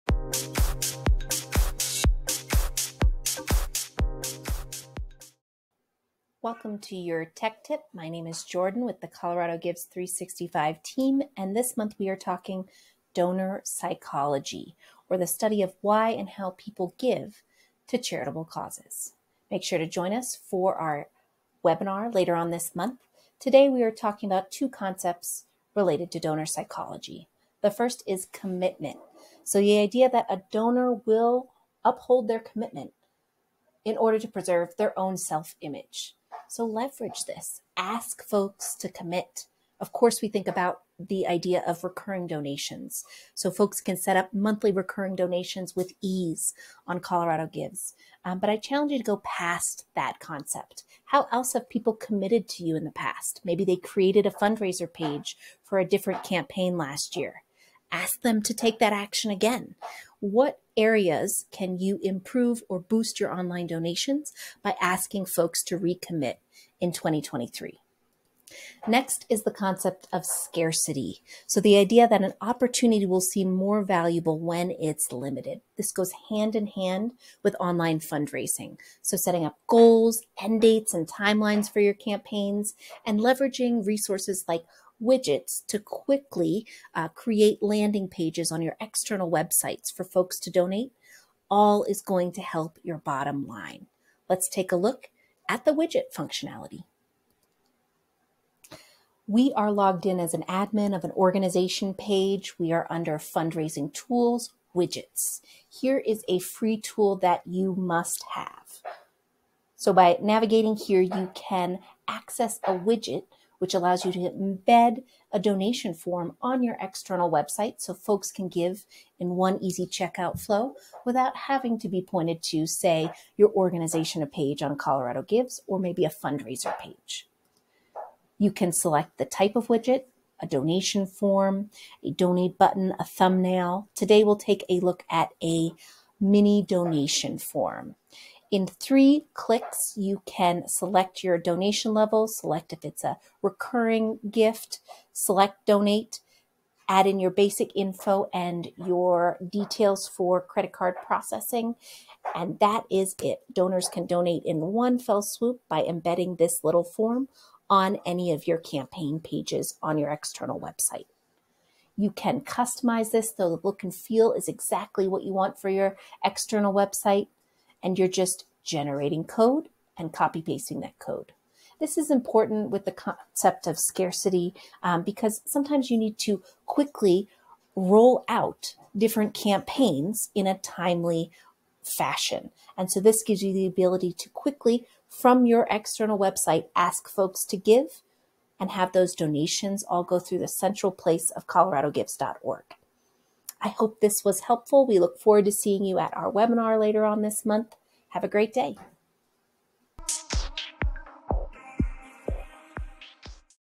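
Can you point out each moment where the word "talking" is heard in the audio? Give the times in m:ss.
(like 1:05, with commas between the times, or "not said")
0:12, 0:23.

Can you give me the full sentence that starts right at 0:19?
Make sure to join us for our webinar later on this month.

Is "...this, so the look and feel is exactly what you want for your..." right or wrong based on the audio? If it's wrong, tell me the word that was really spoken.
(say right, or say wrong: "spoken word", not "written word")
right.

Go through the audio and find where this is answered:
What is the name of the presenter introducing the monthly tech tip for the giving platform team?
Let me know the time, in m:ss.
0:08.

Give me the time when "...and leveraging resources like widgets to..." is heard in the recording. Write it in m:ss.
1:23.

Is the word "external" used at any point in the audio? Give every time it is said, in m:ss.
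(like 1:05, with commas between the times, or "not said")
1:28, 1:56, 2:40, 2:46, 3:05.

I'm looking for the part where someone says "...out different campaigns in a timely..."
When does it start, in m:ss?
2:58.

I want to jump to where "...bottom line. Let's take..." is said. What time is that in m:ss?
1:32.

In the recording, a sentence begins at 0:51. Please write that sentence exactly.
How else have people committed to you in the past?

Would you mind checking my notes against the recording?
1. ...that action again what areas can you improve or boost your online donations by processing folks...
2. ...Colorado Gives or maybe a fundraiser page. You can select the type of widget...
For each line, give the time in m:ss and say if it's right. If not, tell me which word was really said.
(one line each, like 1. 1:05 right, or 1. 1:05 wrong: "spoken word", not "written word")
1. 0:58 wrong: "asking", not "processing"
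2. 2:04 right.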